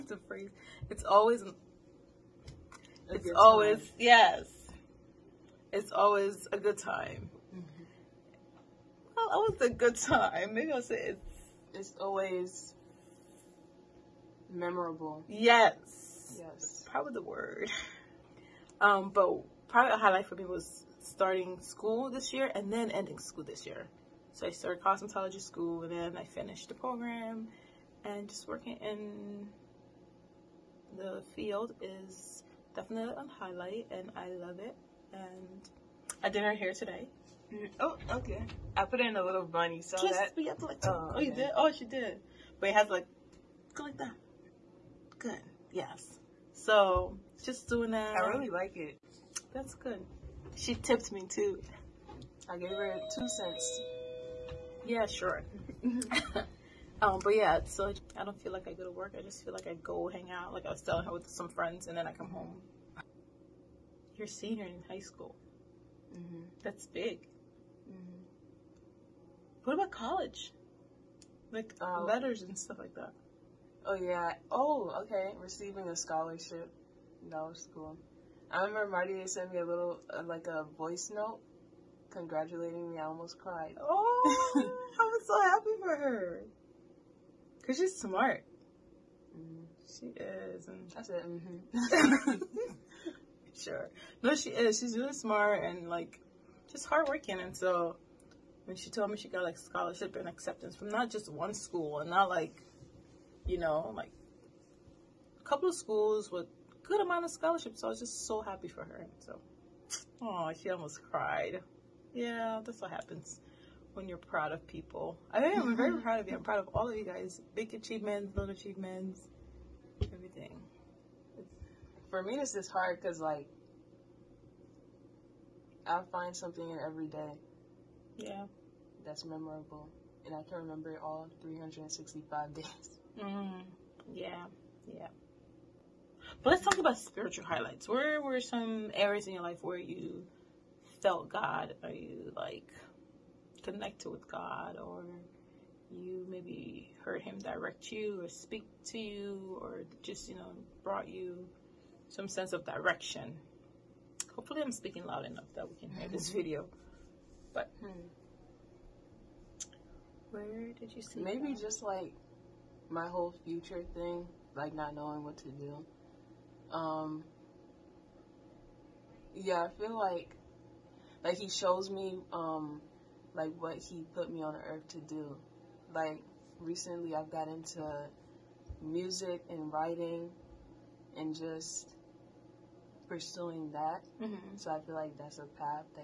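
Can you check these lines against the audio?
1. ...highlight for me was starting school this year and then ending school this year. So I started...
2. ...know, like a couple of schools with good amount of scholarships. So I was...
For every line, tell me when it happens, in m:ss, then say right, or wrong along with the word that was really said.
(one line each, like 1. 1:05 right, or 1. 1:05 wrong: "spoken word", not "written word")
1. 0:19 right
2. 1:43 right.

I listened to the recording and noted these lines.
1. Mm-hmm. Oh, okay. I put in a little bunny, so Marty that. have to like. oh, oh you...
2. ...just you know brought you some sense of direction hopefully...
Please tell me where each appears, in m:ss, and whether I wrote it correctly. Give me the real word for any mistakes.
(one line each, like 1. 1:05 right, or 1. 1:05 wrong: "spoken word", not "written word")
1. 0:37 wrong: "Just", not "Marty"
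2. 2:30 right.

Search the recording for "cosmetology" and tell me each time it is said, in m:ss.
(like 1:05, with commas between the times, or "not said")
0:24.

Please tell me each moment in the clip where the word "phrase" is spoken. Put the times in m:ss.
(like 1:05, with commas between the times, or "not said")
0:00.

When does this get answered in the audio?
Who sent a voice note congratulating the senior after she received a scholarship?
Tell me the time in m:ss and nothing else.
1:18.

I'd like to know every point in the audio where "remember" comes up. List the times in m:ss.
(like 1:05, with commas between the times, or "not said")
1:18, 2:10.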